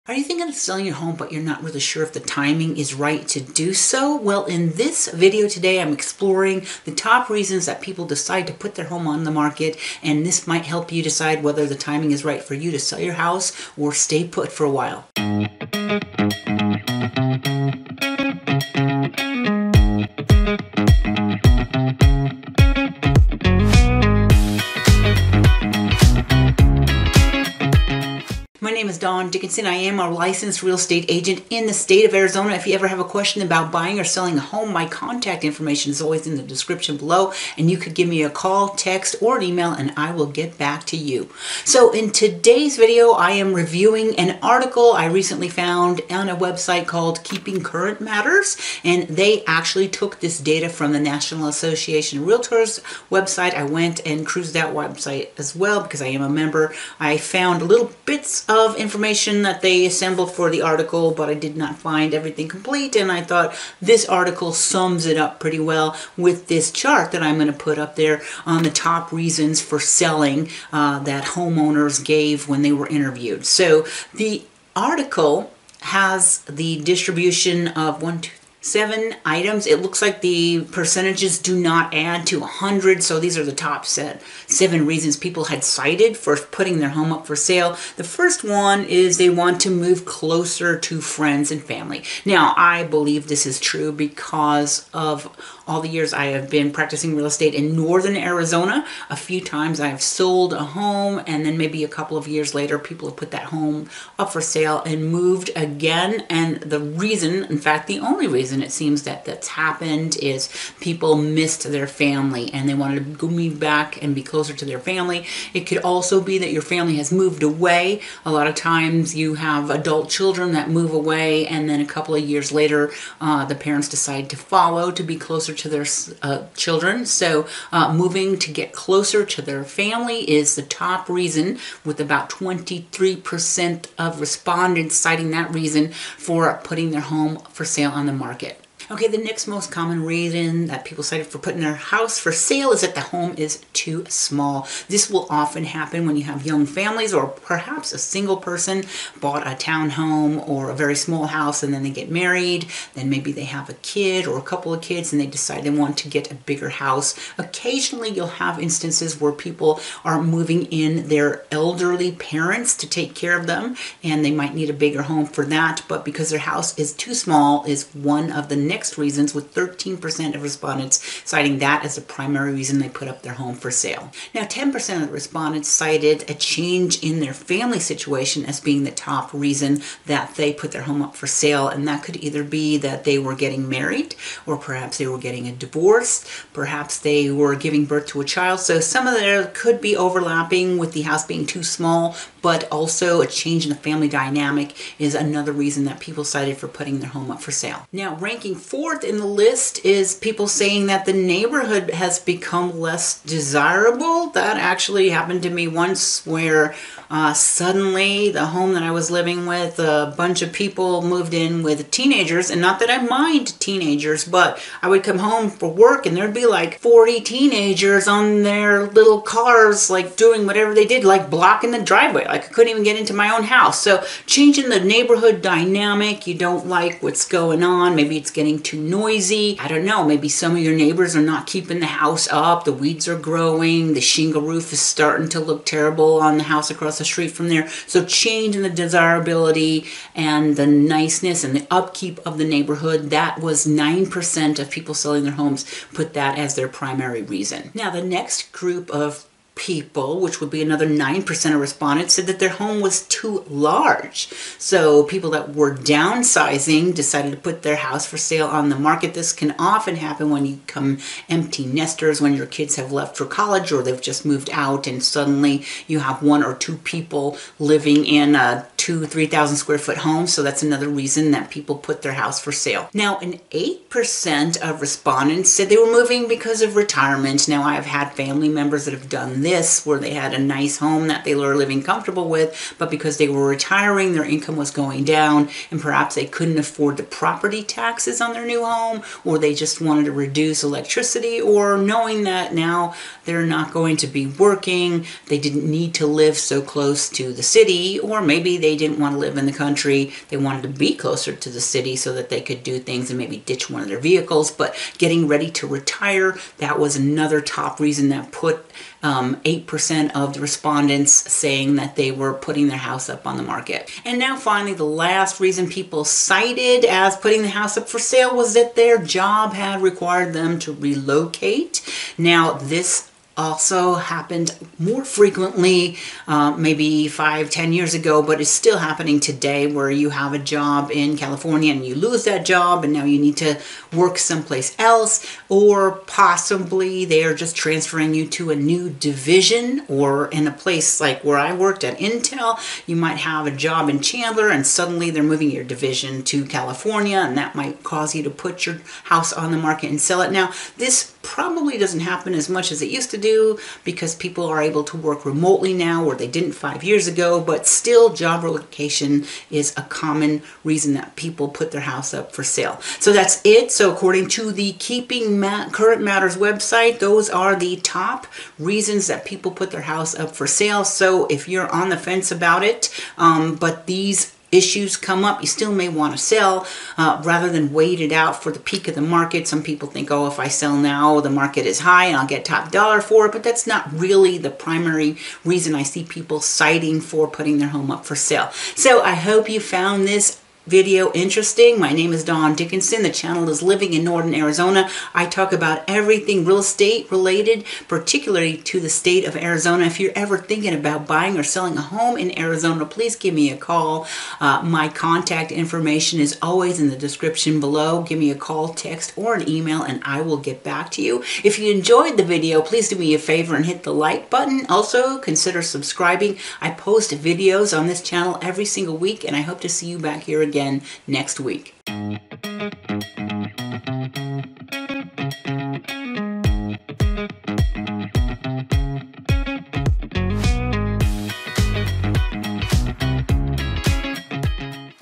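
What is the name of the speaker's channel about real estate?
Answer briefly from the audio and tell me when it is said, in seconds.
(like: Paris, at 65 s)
Living in Northern Arizona, at 393 s.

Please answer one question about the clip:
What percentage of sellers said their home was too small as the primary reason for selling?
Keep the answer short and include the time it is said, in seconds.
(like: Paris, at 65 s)
13%, at 169 s.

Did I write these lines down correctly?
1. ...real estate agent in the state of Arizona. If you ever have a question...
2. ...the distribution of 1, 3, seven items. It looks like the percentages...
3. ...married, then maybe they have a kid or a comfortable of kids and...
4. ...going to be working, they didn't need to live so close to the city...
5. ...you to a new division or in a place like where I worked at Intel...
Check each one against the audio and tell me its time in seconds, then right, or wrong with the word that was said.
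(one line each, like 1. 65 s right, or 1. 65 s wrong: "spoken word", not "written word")
1. 30 s right
2. 76 s wrong: "2", not "3"
3. 152 s wrong: "couple", not "comfortable"
4. 293 s right
5. 338 s right.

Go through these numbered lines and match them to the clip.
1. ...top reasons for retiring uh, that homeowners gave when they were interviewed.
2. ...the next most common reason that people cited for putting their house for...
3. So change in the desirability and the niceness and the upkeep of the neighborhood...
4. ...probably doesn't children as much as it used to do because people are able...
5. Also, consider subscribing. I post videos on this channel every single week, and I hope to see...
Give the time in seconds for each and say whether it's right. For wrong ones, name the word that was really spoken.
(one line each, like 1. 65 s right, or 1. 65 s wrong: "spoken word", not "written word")
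1. 68 s wrong: "selling", not "retiring"
2. 139 s right
3. 237 s right
4. 351 s wrong: "happen", not "children"
5. 414 s right.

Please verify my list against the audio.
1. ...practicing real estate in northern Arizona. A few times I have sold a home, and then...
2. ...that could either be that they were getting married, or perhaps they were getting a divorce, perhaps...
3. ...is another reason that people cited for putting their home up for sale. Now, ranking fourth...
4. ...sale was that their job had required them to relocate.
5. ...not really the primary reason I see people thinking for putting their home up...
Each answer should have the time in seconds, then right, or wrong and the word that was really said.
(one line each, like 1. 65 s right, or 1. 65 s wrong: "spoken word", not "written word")
1. 96 s right
2. 181 s right
3. 194 s right
4. 317 s right
5. 383 s wrong: "citing", not "thinking".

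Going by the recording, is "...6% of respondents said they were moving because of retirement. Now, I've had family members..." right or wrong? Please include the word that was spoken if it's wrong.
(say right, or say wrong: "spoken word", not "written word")
wrong: "8", not "6".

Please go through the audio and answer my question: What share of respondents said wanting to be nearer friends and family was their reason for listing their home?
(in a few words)
23%.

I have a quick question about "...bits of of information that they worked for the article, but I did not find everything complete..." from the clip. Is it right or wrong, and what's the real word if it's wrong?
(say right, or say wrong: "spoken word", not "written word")
wrong: "assembled", not "worked".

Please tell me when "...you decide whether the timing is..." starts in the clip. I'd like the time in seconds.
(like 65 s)
10 s.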